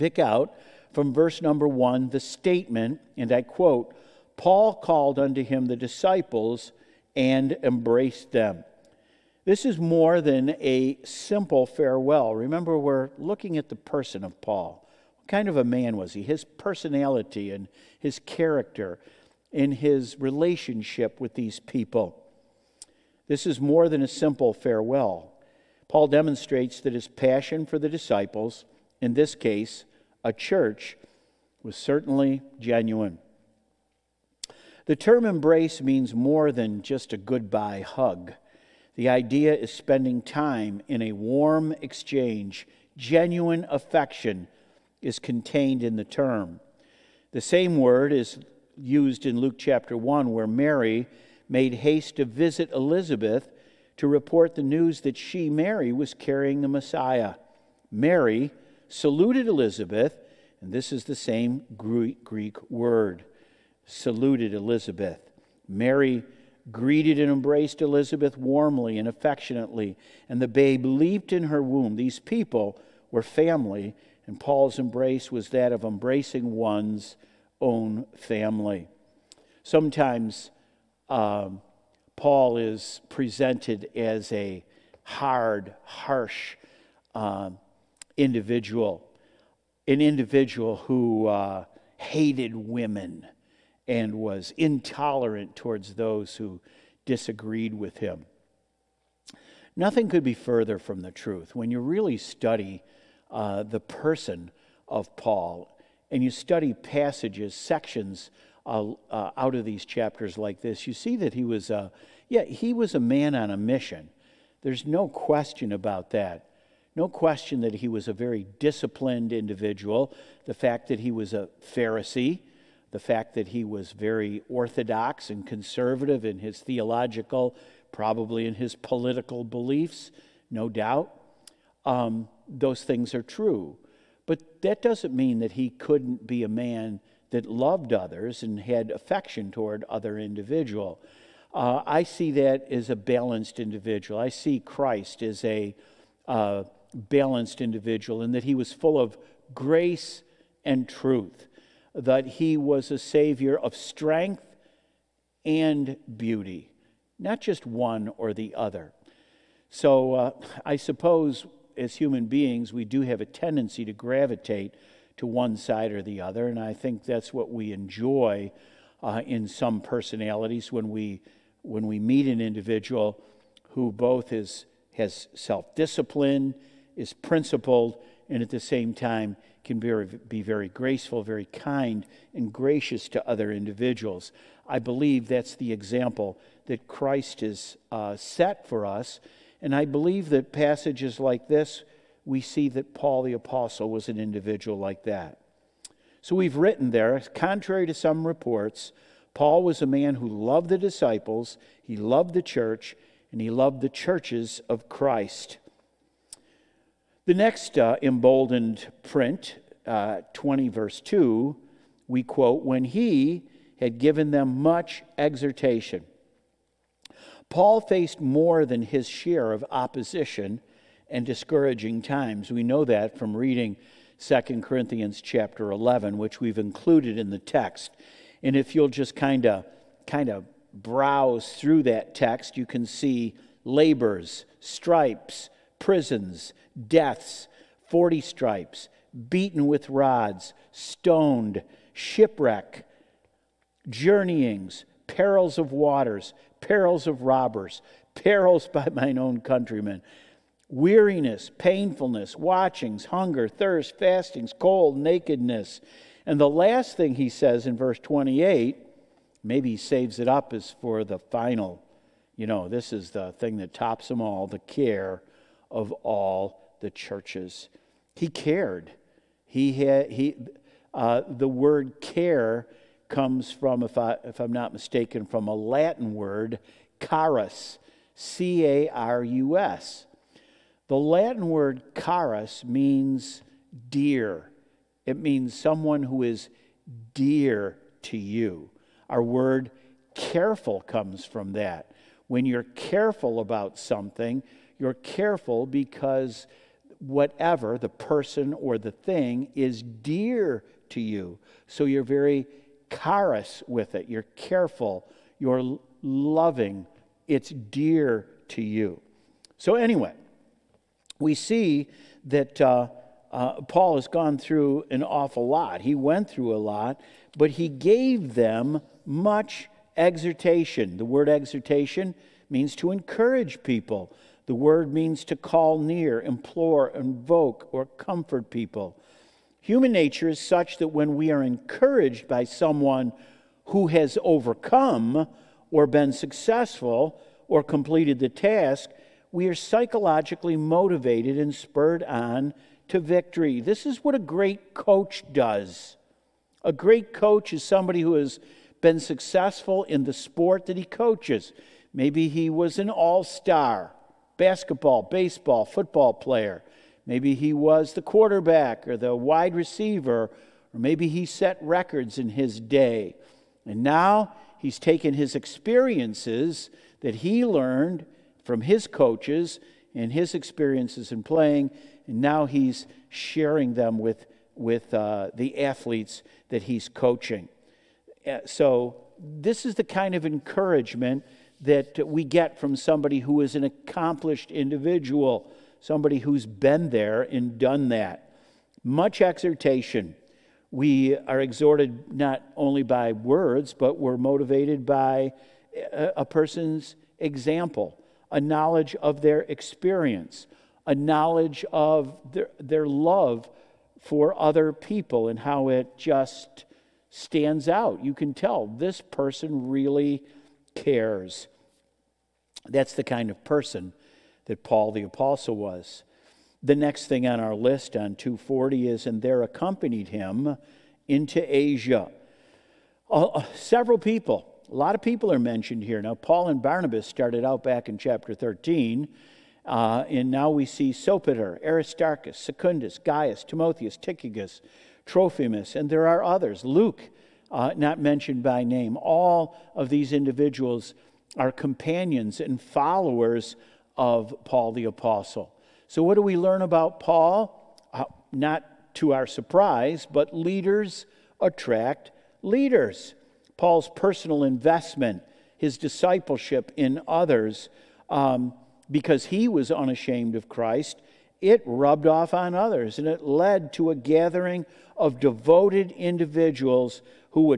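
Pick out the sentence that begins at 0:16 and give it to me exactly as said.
His personality and his character in his relationship with these people.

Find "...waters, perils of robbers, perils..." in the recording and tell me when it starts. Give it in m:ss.
4:05.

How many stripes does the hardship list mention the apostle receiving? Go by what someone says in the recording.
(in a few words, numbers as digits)
40.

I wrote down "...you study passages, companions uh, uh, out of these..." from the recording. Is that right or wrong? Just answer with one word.
wrong.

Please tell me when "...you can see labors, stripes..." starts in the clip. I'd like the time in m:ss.
3:52.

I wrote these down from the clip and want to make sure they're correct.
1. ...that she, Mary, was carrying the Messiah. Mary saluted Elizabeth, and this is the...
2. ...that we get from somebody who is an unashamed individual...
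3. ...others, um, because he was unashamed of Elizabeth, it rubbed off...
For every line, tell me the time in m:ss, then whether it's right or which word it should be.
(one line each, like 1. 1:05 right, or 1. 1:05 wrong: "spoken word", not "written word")
1. 0:55 right
2. 6:21 wrong: "accomplished", not "unashamed"
3. 7:37 wrong: "Christ", not "Elizabeth".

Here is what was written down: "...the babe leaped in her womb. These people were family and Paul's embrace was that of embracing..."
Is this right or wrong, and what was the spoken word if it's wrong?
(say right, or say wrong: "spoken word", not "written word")
right.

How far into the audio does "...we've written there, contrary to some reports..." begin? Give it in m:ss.
3:16.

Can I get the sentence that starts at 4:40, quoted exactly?
The Latin word carus means dear, it means someone who is dear to you.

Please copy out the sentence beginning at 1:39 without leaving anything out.
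Nothing could be further from the truth.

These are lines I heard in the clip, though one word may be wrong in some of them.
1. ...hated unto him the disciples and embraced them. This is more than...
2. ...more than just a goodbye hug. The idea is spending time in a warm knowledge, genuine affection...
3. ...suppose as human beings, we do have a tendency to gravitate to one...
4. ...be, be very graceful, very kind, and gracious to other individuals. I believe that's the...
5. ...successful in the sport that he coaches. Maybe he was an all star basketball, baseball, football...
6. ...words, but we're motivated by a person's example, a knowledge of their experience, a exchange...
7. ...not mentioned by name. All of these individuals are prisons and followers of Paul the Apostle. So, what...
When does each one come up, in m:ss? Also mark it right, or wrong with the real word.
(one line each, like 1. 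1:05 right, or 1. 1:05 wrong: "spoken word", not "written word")
1. 0:04 wrong: "called", not "hated"
2. 0:36 wrong: "exchange", not "knowledge"
3. 2:40 right
4. 2:59 right
5. 5:48 right
6. 6:33 wrong: "knowledge", not "exchange"
7. 7:17 wrong: "companions", not "prisons".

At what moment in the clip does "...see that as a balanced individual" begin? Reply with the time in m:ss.
2:22.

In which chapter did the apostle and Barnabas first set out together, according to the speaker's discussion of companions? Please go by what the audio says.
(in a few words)
Chapter 13.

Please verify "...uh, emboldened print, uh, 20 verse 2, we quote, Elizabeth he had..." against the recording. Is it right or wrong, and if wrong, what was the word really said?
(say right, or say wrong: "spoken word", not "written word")
wrong: "When", not "Elizabeth".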